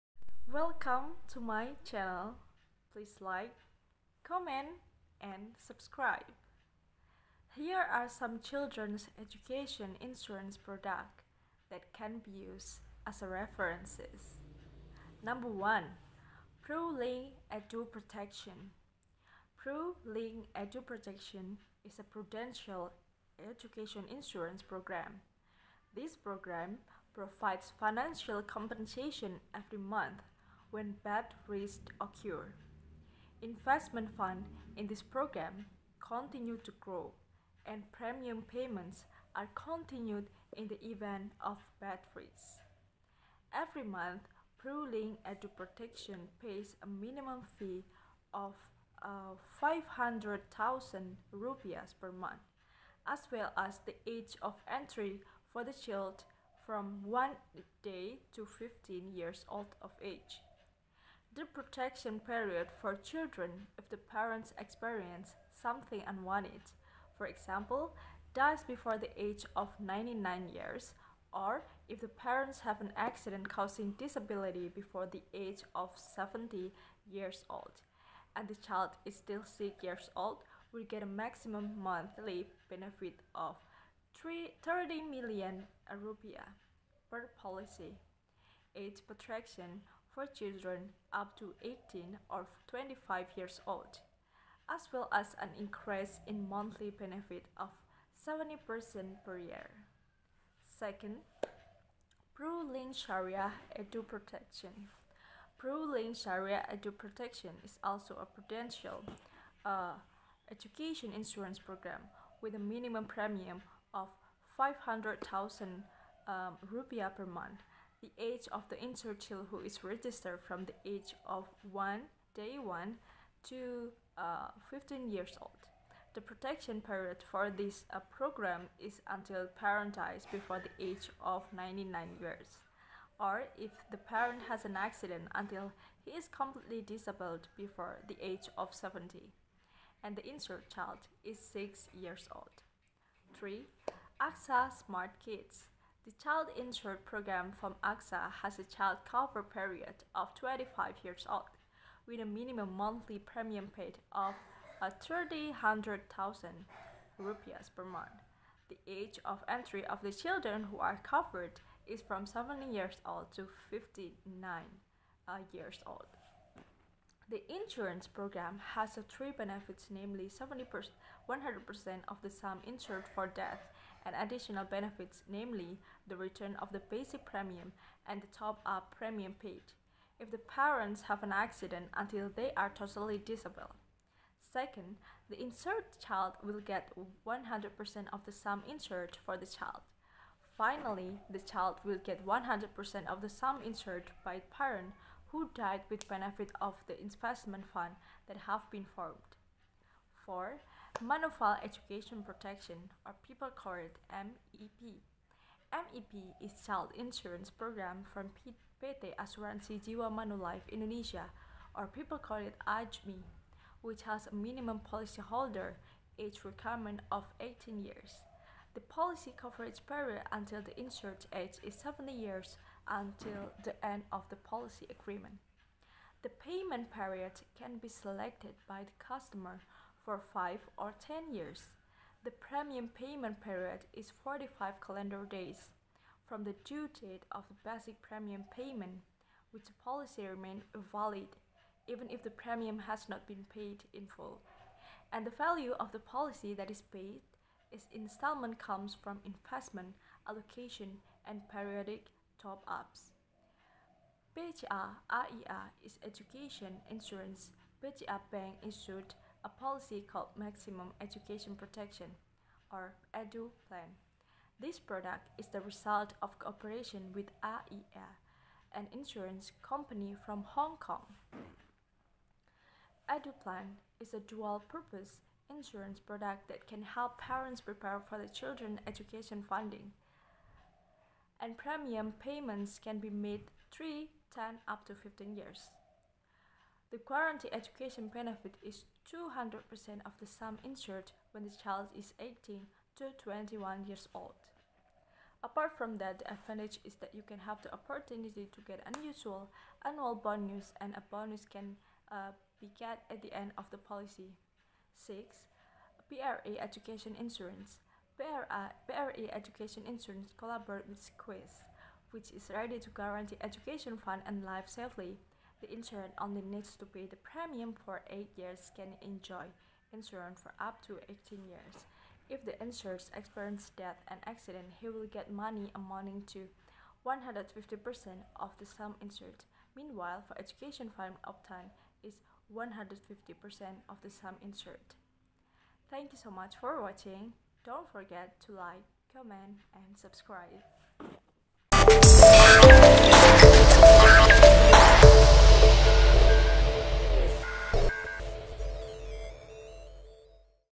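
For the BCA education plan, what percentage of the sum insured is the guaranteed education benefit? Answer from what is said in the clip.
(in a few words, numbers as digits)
200%.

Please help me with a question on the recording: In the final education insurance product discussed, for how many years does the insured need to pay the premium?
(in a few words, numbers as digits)
8 years.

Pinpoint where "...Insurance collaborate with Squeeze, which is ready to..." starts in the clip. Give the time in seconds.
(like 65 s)
309 s.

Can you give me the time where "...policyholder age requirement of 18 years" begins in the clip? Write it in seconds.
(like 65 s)
214 s.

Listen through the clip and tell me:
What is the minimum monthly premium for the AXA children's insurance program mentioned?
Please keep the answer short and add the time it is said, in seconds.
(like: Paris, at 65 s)
300,000 rupees, at 154 s.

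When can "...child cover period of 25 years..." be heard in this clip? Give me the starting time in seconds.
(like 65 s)
148 s.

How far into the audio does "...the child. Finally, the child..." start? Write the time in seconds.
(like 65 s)
189 s.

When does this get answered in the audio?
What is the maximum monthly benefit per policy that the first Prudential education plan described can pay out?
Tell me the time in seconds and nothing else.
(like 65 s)
84 s.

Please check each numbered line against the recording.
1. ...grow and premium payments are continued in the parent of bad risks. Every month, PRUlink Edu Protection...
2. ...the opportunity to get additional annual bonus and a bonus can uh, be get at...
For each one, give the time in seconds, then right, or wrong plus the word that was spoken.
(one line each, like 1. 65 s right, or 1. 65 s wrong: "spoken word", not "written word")
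1. 36 s wrong: "event", not "parent"
2. 297 s wrong: "unusual", not "additional".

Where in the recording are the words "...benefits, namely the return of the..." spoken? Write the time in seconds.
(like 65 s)
174 s.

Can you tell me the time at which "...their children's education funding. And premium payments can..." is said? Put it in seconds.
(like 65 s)
278 s.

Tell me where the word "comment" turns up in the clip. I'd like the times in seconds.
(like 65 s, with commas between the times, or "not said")
4 s, 339 s.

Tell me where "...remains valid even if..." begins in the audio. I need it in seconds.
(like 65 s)
240 s.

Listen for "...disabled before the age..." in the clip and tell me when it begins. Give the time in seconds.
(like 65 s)
136 s.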